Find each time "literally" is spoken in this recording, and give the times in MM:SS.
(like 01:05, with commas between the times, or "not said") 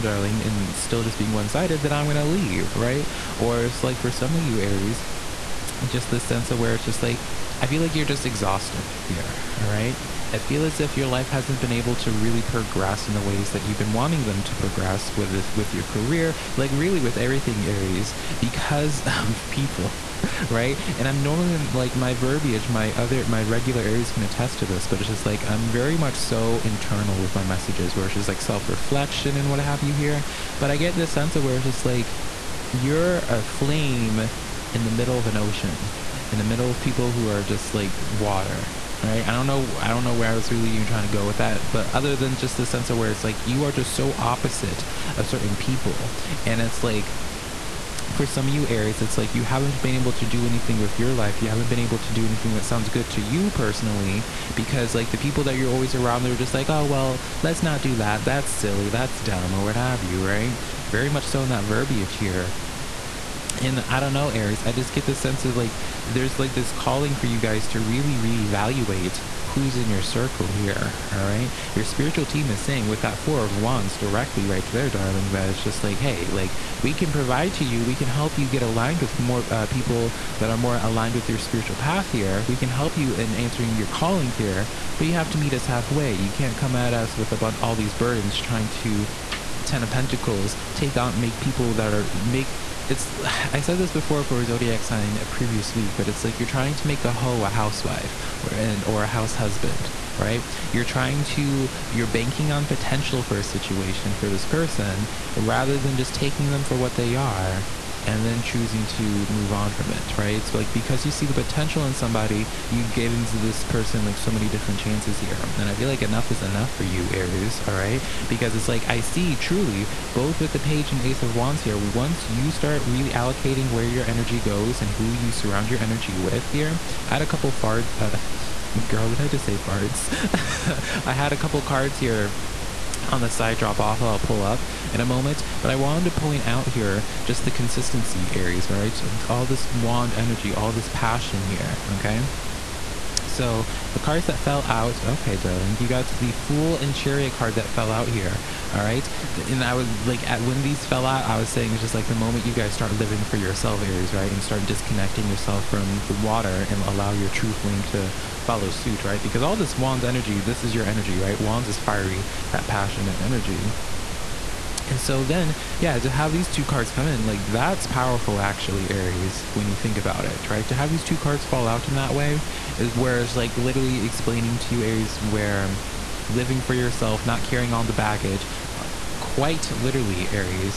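02:53, 02:59.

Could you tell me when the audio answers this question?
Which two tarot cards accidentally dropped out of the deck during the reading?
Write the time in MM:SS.
02:26.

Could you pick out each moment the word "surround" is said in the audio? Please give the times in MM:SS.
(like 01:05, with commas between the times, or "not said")
02:05.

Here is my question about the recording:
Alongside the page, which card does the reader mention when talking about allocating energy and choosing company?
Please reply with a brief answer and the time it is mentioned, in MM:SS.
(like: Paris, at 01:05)
Ace of Wands, at 02:01.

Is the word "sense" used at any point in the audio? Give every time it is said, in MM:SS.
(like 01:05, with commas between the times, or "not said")
00:06, 00:31, 00:42, 01:05.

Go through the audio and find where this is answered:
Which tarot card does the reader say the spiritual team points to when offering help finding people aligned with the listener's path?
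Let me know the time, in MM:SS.
01:13.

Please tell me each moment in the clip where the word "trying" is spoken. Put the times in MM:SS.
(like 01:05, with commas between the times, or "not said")
00:40, 01:28, 01:36, 01:40.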